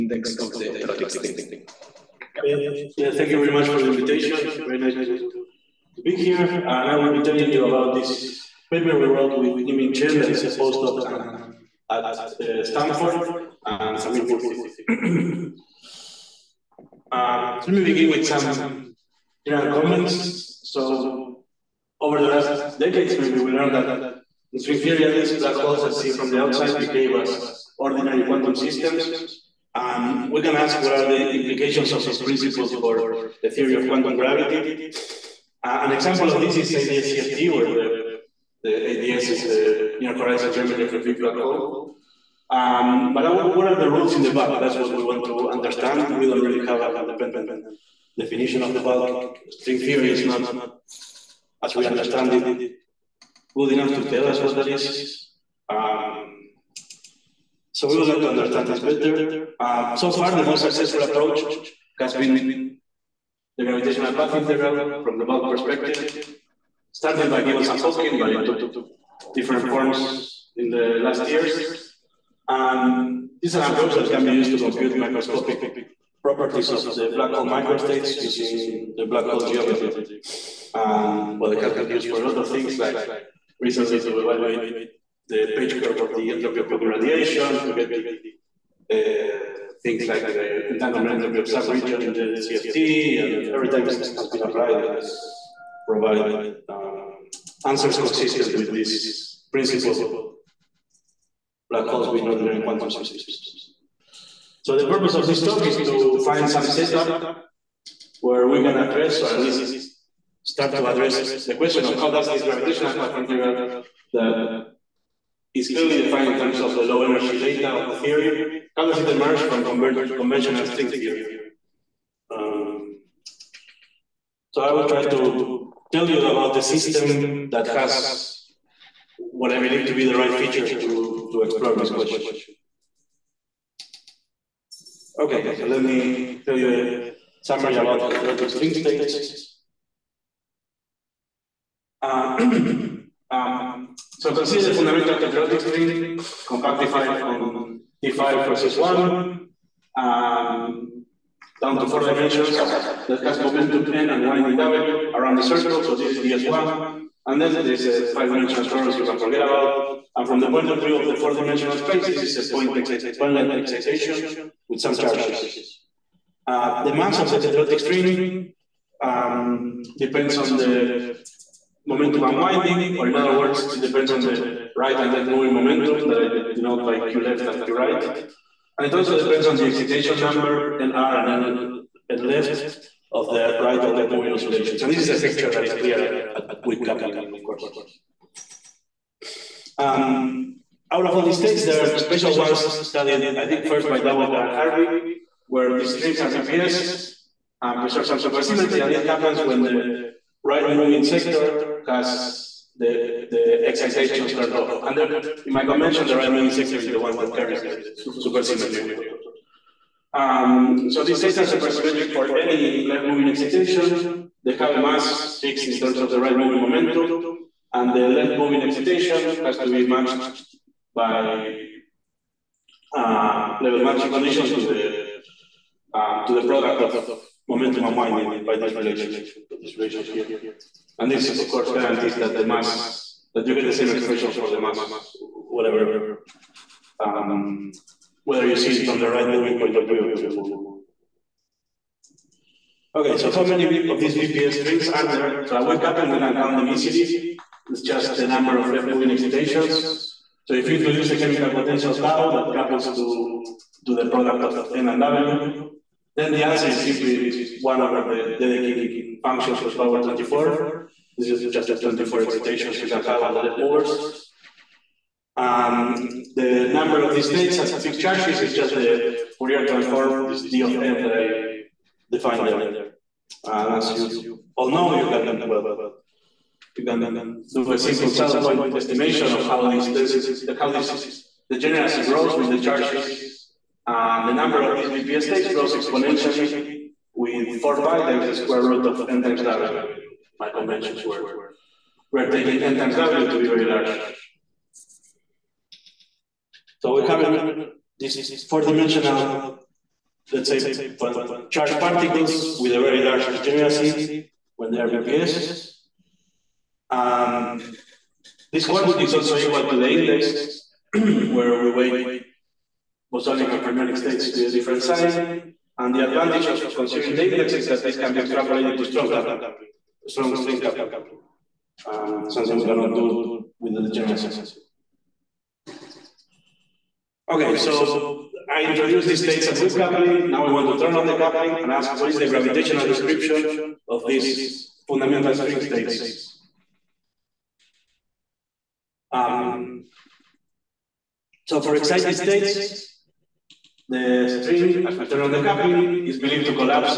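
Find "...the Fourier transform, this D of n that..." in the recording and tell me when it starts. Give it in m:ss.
4:28.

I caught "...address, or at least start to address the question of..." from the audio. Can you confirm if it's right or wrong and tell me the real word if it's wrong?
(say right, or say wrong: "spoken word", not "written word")
right.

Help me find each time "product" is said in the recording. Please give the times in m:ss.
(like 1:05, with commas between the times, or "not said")
3:46, 4:14.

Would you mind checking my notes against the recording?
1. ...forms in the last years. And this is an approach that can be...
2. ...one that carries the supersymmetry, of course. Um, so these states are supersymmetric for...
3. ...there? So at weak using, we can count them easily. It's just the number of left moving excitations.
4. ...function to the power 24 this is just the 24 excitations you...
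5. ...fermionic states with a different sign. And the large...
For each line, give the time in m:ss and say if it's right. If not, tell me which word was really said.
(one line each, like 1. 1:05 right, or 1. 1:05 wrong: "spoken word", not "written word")
1. 1:09 right
2. 3:26 right
3. 4:05 wrong: "coupling", not "using"
4. 4:19 right
5. 5:13 wrong: "advantage", not "large".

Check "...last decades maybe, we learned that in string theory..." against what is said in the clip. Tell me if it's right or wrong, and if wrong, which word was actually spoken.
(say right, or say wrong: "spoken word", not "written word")
right.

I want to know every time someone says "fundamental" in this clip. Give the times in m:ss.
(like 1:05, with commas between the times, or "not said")
2:24, 5:34.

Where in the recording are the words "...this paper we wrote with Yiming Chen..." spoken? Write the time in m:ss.
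0:07.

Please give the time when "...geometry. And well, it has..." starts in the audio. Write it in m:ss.
1:19.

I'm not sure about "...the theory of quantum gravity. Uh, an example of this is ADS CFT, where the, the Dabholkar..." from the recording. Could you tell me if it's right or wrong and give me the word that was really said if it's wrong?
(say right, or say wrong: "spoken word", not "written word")
wrong: "ADS", not "Dabholkar".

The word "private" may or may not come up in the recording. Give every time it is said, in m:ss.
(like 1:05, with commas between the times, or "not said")
not said.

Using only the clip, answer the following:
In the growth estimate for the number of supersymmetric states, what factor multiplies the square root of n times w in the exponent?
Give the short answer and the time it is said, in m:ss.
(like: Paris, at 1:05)
4 pi, at 4:47.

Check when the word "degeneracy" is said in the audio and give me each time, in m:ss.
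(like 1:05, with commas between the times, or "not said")
4:41, 5:03.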